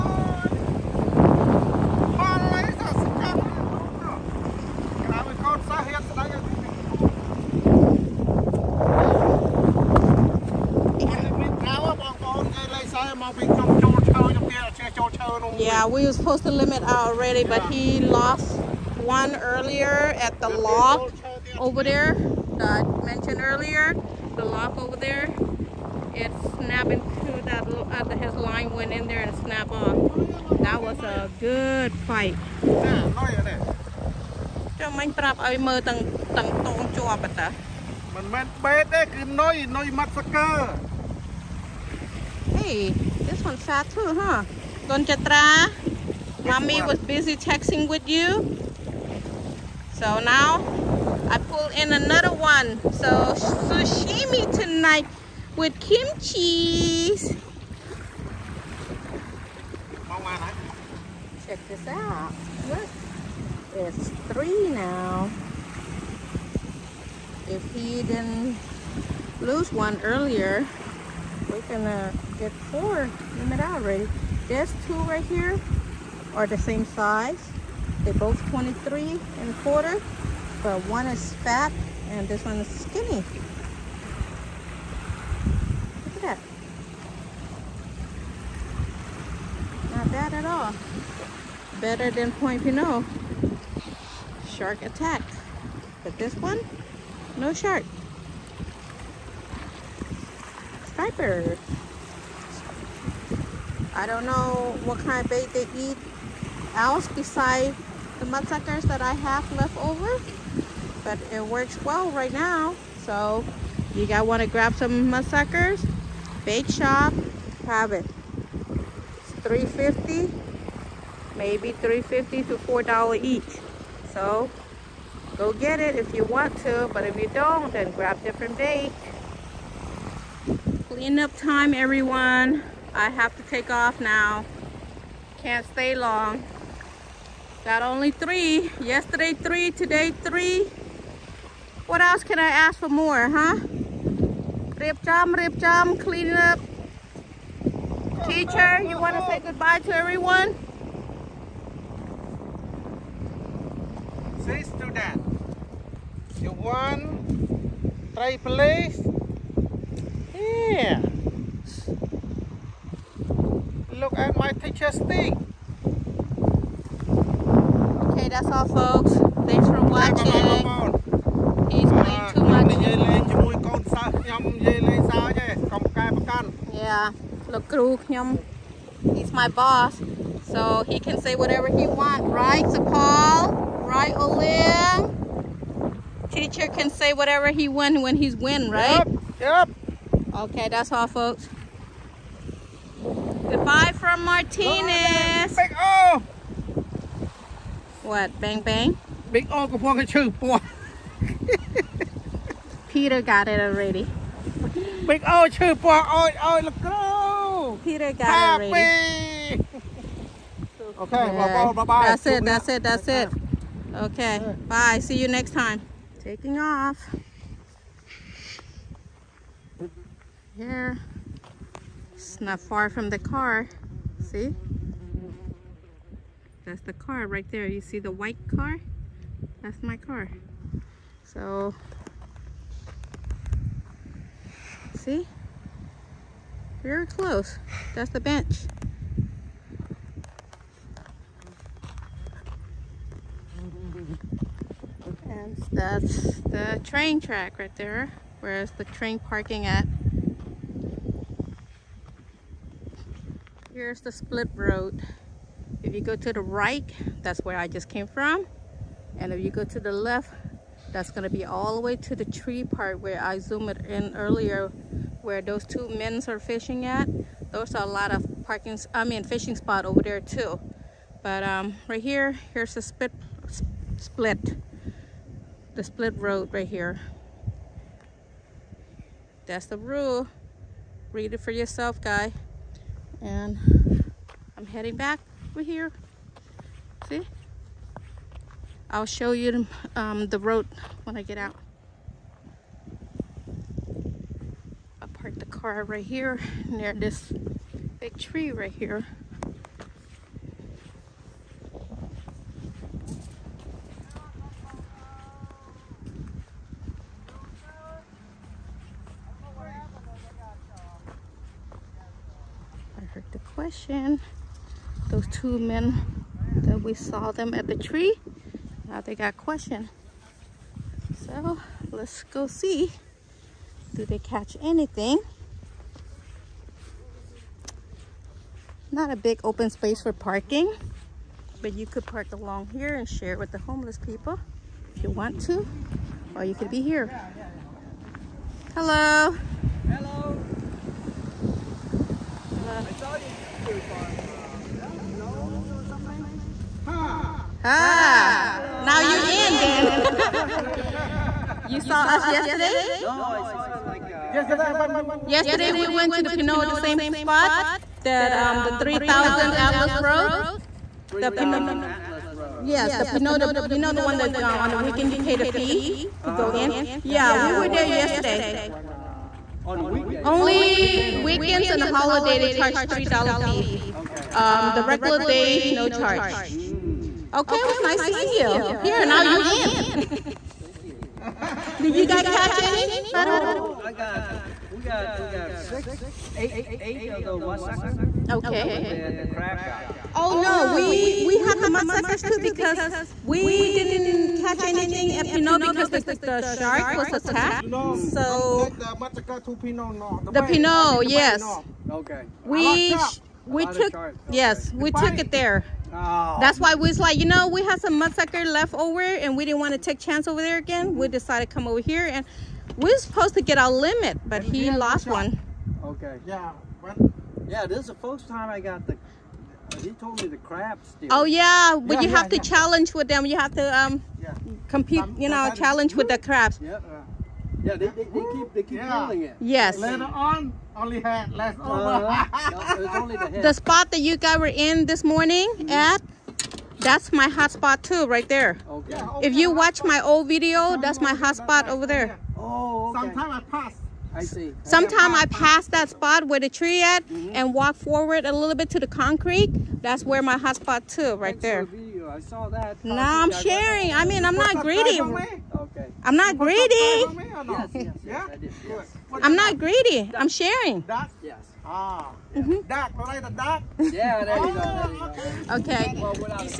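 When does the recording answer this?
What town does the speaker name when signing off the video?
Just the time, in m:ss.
3:14.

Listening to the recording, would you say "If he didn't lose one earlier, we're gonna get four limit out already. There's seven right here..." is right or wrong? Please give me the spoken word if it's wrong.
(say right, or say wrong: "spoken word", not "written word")
wrong: "two", not "seven".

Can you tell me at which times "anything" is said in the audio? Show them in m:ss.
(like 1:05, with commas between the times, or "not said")
5:24, 6:34.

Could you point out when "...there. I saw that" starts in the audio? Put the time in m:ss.
7:31.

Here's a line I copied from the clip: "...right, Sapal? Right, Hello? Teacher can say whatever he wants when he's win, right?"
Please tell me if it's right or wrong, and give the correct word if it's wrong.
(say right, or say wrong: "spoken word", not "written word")
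wrong: "Olim", not "Hello".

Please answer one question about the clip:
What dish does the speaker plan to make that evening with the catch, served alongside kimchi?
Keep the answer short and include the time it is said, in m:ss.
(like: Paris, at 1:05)
Sashimi, at 0:53.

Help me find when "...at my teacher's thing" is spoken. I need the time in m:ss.
2:44.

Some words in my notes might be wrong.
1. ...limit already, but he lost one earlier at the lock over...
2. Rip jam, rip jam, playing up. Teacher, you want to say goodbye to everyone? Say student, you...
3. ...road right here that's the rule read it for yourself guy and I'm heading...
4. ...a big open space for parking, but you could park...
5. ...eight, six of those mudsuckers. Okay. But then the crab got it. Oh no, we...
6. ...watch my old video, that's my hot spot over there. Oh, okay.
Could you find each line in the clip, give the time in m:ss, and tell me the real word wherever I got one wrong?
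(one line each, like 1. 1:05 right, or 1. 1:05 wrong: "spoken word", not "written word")
1. 0:16 right
2. 2:24 wrong: "cleaning", not "playing"
3. 4:36 right
4. 5:29 right
5. 6:26 wrong: "eight", not "six"
6. 7:19 right.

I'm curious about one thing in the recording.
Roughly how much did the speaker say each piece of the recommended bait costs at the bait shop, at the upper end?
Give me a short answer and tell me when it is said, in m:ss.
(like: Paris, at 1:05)
$4, at 2:02.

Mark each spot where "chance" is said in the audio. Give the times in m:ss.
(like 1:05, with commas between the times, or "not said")
6:49.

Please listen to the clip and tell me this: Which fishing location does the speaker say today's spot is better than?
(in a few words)
Point Pinole.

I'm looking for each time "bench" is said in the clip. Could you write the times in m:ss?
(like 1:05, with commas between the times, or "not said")
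3:58.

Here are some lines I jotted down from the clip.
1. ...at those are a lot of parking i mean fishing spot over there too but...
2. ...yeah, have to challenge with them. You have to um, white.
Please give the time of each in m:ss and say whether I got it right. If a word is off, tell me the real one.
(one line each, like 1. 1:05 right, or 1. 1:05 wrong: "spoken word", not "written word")
1. 4:26 right
2. 7:02 wrong: "compete", not "white".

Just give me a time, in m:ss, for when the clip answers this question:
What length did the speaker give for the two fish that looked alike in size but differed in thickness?
1:18.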